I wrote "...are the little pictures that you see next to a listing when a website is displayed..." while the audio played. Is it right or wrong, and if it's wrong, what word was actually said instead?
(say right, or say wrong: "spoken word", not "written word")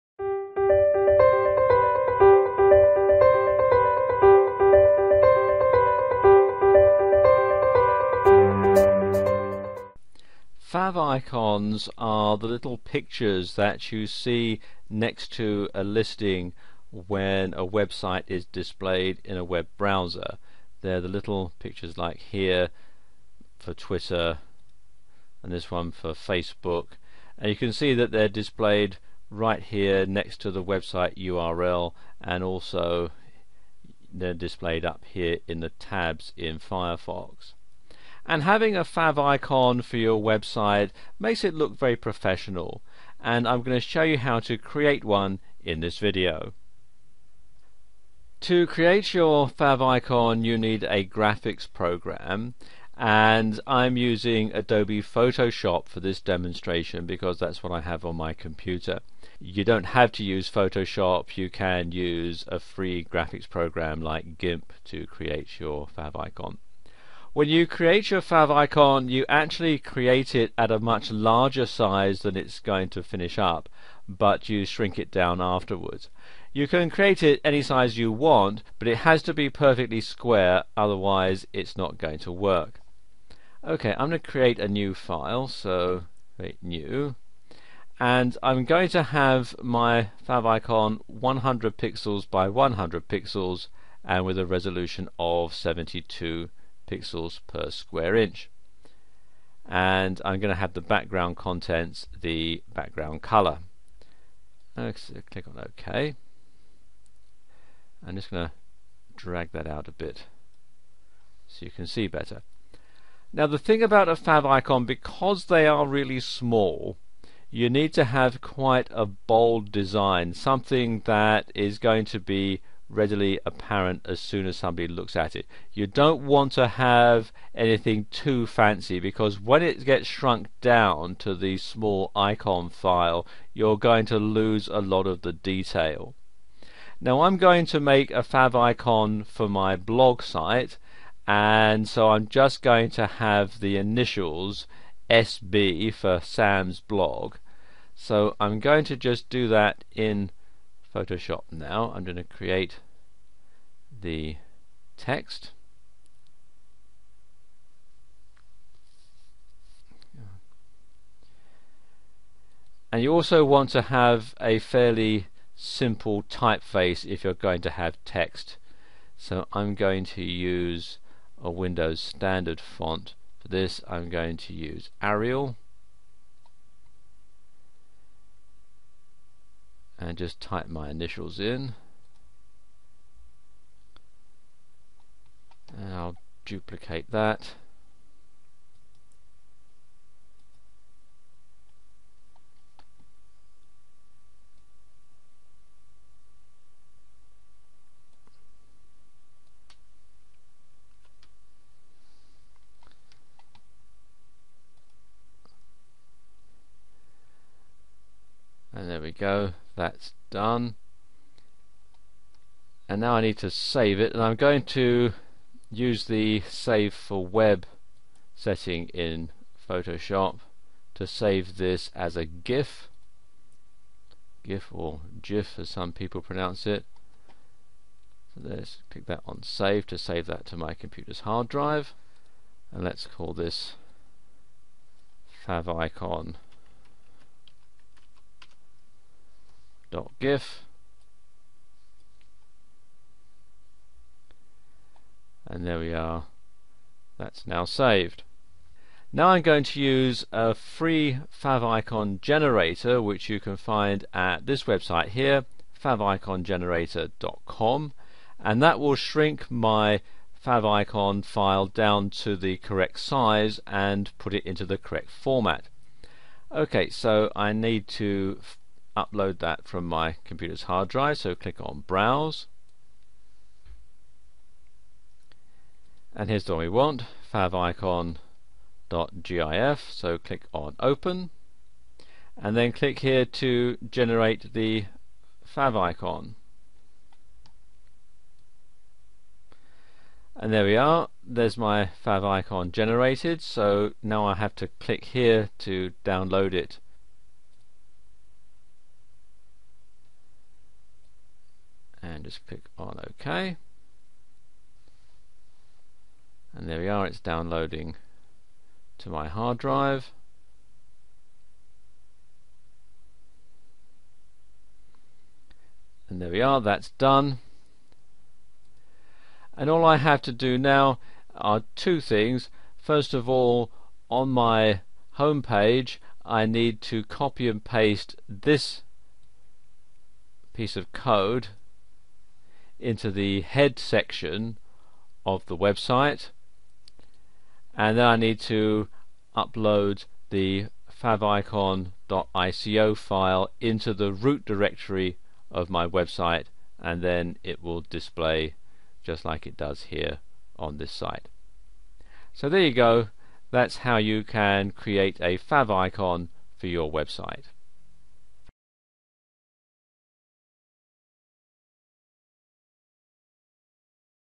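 right.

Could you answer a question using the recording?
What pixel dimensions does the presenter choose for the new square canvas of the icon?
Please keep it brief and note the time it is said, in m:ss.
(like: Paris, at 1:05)
100 by 100 pixels, at 1:31.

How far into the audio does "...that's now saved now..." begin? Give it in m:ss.
4:07.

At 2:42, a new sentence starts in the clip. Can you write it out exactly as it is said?
And you also want to have a fairly simple typeface if you're going to have text.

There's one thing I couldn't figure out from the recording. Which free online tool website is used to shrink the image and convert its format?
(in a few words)
favicongenerator.com.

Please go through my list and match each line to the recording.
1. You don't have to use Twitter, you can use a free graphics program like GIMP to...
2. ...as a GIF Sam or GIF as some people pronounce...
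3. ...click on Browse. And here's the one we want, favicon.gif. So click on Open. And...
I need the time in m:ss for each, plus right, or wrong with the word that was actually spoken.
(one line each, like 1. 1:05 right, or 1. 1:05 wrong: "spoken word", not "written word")
1. 0:59 wrong: "Photoshop", not "Twitter"
2. 3:41 wrong: "GIF", not "Sam"
3. 4:31 right.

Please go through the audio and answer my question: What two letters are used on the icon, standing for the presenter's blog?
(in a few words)
SB.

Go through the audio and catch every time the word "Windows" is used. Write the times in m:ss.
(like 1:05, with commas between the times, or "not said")
2:51.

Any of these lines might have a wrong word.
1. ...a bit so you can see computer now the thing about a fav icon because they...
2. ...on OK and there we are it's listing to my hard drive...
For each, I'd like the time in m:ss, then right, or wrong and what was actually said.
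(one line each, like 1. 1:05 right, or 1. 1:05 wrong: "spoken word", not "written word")
1. 1:49 wrong: "better", not "computer"
2. 5:02 wrong: "downloading", not "listing".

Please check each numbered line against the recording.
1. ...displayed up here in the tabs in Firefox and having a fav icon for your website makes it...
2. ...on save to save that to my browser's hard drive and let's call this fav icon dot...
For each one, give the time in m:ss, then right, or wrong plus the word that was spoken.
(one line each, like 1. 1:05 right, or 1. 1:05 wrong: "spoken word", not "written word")
1. 0:34 right
2. 3:49 wrong: "computer", not "browser".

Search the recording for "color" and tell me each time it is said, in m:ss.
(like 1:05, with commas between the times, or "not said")
1:43.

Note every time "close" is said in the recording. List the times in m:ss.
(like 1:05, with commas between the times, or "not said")
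not said.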